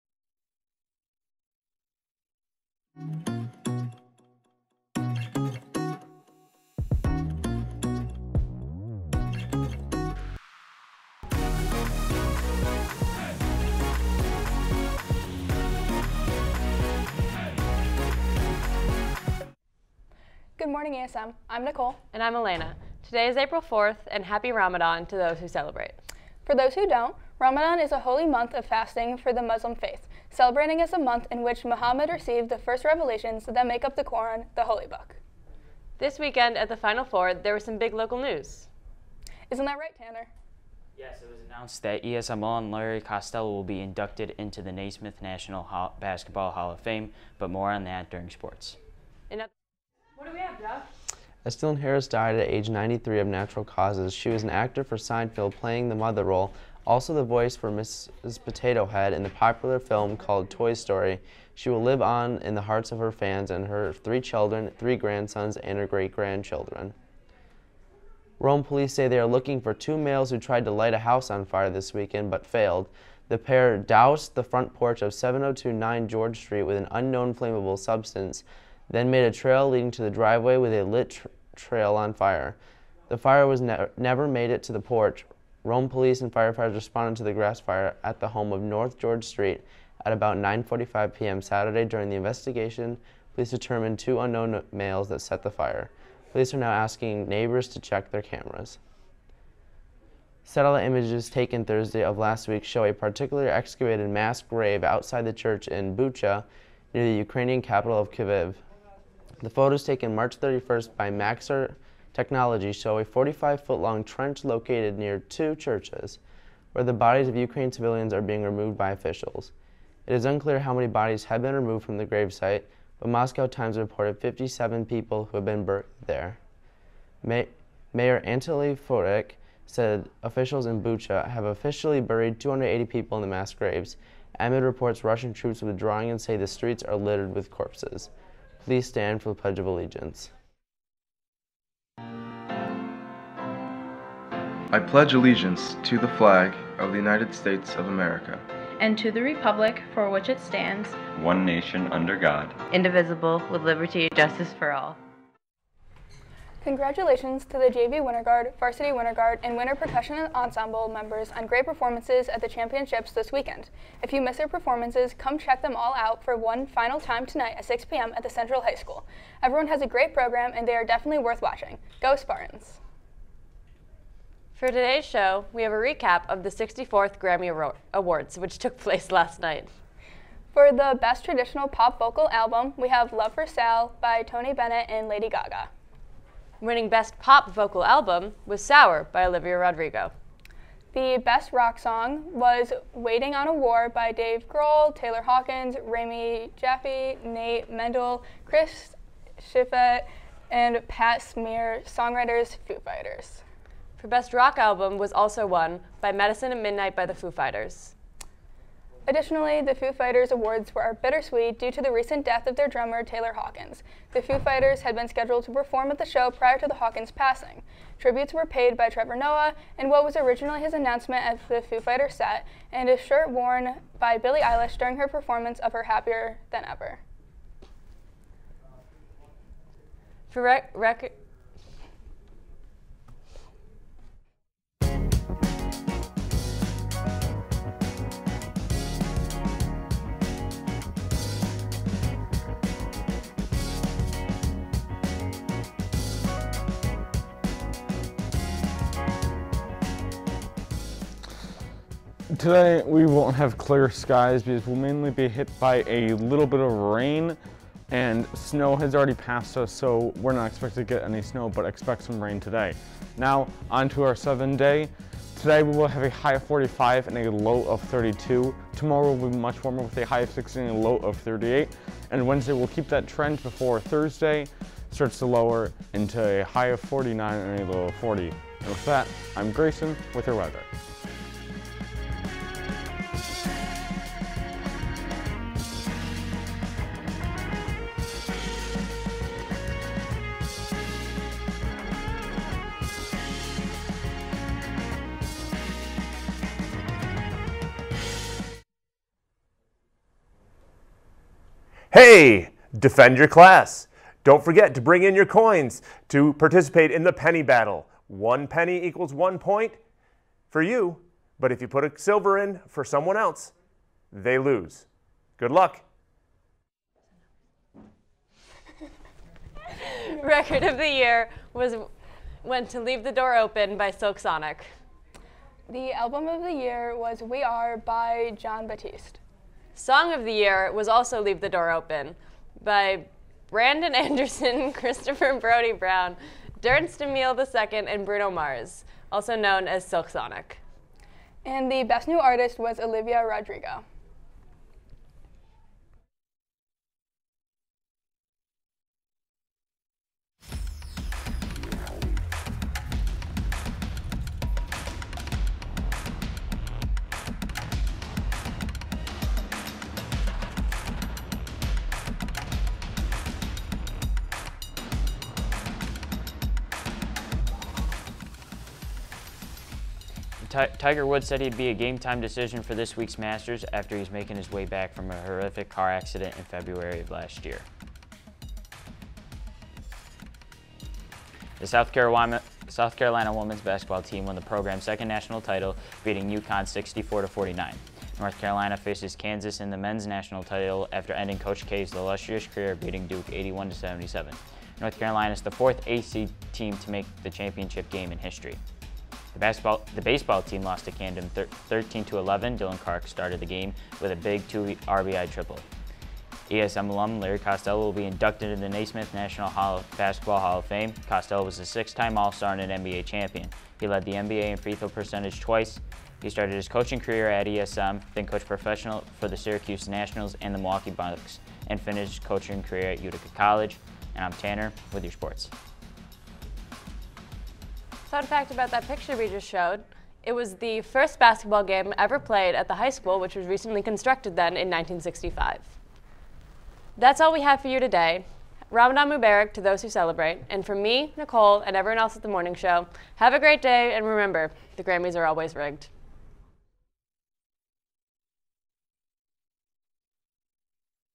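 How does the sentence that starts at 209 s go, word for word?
Additionally, the Foo Fighters awards were bittersweet due to the recent death of their drummer Taylor Hawkins.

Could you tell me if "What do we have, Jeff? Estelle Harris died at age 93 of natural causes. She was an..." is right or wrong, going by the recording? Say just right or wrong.
right.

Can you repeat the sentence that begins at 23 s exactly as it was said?
Today is April 4th, and happy Ramadan to those who celebrate.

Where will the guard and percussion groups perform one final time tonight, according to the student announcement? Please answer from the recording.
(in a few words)
Central High School.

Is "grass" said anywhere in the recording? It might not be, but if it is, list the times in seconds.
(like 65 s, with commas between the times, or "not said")
87 s.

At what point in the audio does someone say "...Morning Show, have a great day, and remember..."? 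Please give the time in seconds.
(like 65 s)
442 s.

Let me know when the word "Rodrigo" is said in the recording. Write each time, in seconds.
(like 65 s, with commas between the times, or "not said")
189 s, 343 s.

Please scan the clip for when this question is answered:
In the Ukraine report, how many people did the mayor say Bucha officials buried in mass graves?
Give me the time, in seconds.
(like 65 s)
132 s.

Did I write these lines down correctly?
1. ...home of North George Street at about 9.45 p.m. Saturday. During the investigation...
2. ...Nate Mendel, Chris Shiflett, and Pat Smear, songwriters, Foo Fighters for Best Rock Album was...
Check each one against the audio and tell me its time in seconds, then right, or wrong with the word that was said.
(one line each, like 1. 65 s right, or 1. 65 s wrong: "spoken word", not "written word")
1. 88 s right
2. 197 s right.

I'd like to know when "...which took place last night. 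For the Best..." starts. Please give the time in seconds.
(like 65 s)
178 s.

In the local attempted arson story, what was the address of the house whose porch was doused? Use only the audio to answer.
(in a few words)
7029 George Street.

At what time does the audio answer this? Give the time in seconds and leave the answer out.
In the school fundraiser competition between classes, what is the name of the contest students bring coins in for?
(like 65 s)
307 s.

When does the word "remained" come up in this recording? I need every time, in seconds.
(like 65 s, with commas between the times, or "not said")
not said.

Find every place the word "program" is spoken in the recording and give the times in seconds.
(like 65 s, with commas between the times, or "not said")
170 s, 384 s.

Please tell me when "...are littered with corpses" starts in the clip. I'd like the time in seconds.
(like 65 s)
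136 s.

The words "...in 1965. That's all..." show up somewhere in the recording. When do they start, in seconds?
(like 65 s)
434 s.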